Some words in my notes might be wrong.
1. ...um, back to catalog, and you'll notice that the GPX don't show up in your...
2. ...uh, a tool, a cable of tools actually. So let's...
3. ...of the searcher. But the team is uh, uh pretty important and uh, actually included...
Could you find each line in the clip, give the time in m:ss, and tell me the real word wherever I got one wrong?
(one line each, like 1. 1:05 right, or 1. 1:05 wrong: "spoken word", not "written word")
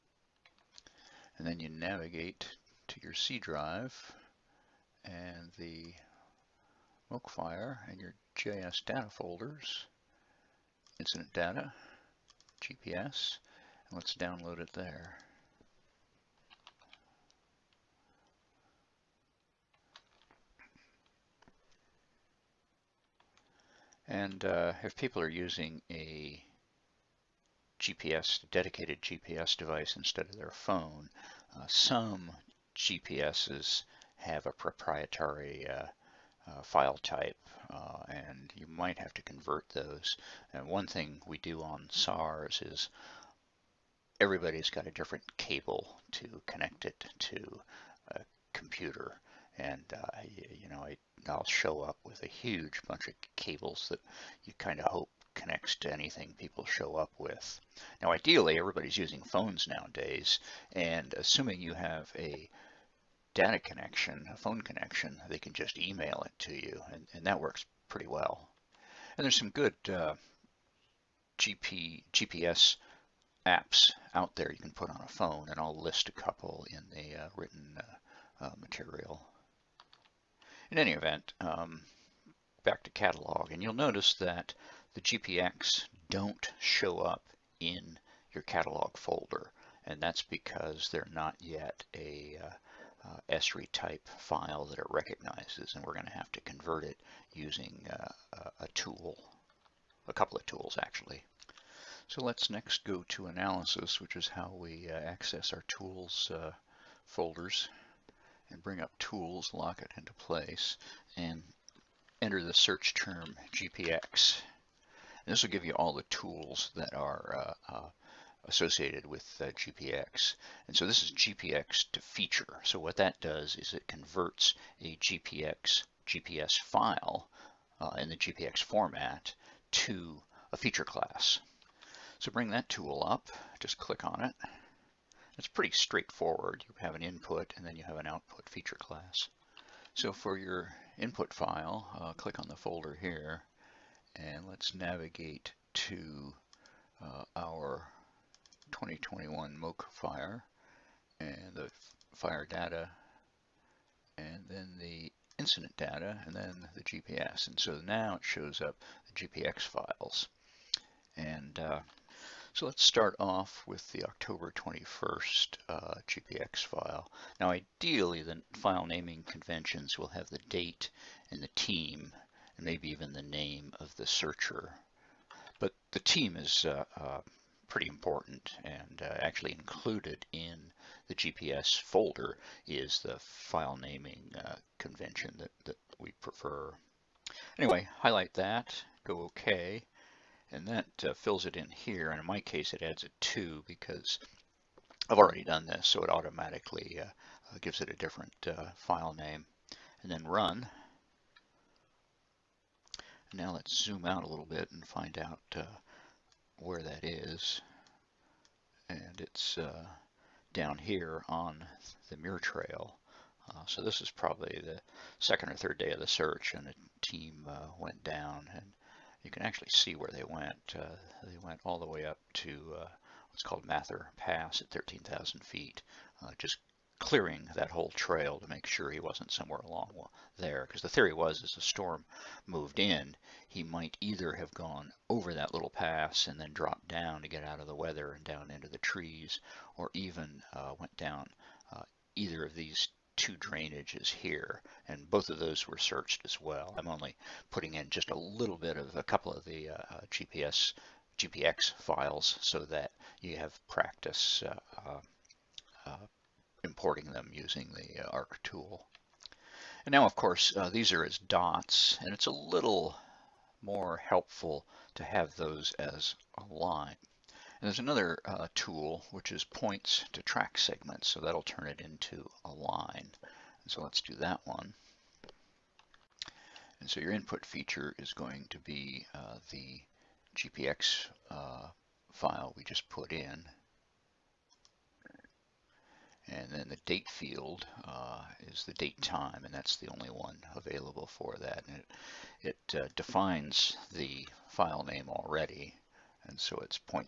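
1. 1:21 right
2. 1:37 wrong: "couple", not "cable"
3. 2:53 right.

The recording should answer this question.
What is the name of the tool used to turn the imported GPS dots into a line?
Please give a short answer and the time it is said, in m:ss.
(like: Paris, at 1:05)
Points to track segments, at 4:29.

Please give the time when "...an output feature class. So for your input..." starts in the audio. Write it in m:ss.
2:17.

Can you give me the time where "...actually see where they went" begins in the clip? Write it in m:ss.
3:39.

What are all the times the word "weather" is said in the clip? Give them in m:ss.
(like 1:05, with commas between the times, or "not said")
3:57.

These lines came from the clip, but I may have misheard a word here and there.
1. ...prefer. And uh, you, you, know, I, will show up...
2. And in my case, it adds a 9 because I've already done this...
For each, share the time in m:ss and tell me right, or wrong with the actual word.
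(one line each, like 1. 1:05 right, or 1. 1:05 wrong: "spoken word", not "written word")
1. 0:48 wrong: "computer", not "prefer"
2. 3:12 wrong: "2", not "9".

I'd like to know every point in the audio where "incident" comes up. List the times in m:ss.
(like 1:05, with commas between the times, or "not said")
0:10, 2:35.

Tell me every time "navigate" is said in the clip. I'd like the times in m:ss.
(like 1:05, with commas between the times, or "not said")
0:01, 2:24.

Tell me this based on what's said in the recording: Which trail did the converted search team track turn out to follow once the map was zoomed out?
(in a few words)
Muir Trail.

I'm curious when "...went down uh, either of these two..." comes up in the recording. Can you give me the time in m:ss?
4:00.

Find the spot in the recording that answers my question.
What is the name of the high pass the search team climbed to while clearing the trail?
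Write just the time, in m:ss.
3:43.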